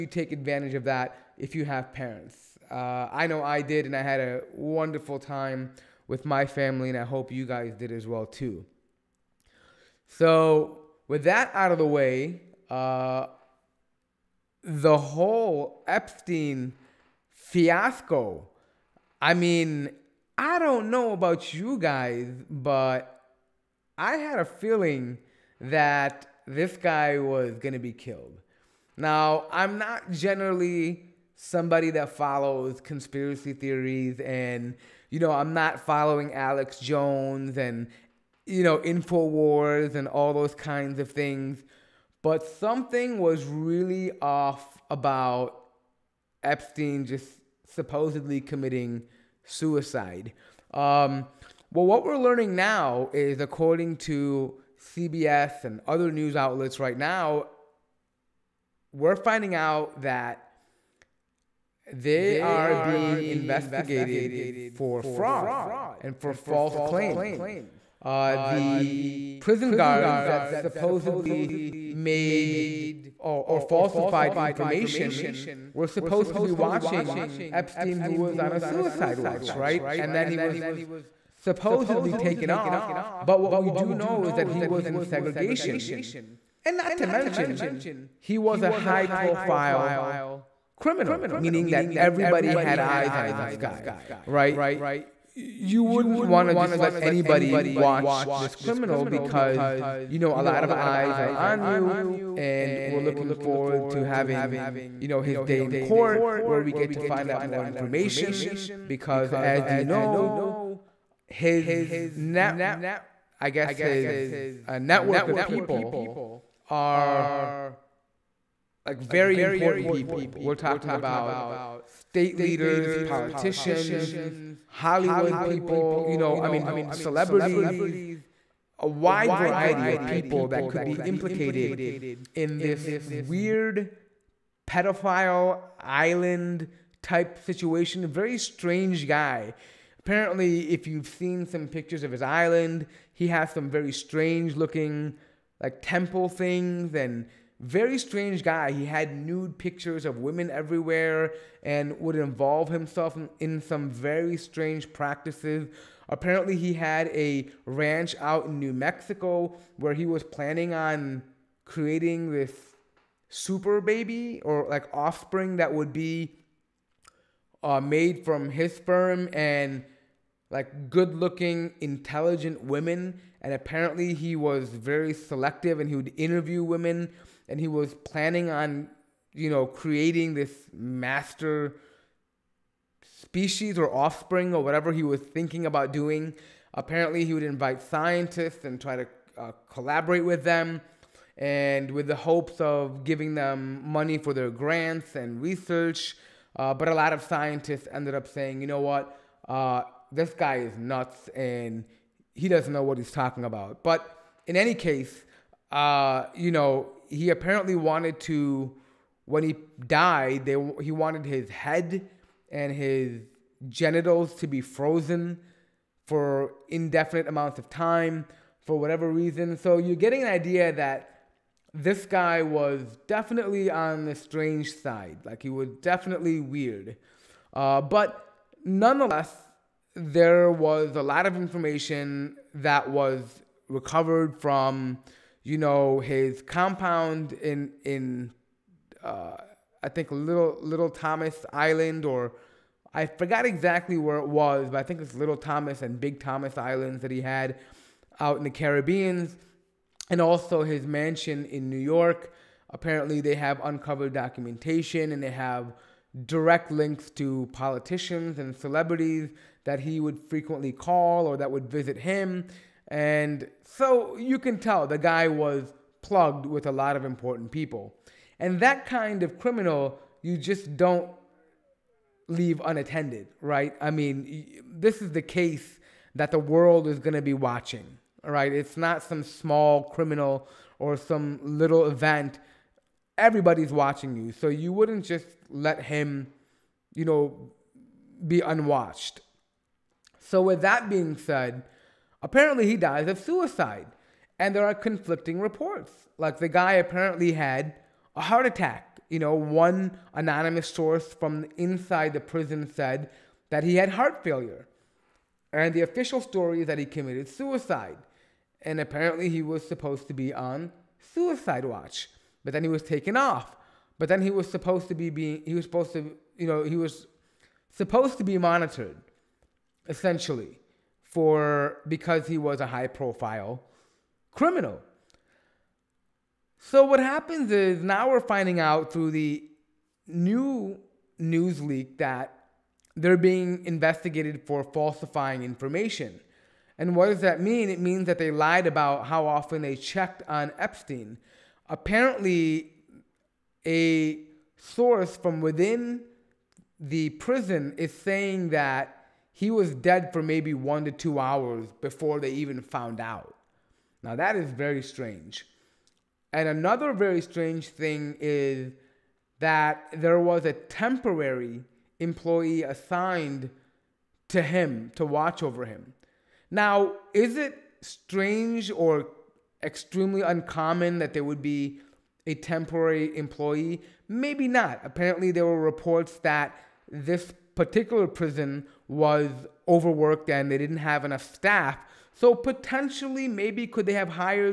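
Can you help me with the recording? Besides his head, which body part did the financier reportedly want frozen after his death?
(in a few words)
His genitals.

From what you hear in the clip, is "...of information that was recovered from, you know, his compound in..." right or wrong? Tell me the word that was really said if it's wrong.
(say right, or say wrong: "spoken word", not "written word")
right.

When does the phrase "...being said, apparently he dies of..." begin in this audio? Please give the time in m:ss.
4:50.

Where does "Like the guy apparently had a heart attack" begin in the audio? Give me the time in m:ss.
4:56.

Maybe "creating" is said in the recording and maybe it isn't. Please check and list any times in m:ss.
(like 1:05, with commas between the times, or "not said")
2:41, 2:59.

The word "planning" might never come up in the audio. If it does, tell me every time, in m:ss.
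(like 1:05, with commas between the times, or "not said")
2:40, 2:58.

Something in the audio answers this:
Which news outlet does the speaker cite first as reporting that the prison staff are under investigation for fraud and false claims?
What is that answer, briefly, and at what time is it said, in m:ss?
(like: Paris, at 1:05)
CBS, at 0:54.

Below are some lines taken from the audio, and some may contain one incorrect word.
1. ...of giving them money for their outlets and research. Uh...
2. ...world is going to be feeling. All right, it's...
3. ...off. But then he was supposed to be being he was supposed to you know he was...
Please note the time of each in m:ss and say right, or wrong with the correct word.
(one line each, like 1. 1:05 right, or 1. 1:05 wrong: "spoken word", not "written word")
1. 3:12 wrong: "grants", not "outlets"
2. 4:36 wrong: "watching", not "feeling"
3. 5:13 right.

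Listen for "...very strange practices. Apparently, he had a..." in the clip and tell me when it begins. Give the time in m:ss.
2:33.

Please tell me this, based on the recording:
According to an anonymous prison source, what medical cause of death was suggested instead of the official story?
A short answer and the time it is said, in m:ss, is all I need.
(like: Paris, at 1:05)
Heart failure, at 5:03.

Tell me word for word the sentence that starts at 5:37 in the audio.
It means that they lied about how often they checked on Epstein.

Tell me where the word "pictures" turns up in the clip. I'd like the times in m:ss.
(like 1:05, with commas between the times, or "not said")
2:21, 2:29.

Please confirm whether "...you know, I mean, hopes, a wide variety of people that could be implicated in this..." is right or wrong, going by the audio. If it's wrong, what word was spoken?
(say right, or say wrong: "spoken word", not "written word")
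wrong: "celebrities", not "hopes".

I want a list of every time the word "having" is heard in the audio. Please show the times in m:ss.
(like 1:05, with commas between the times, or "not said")
1:44.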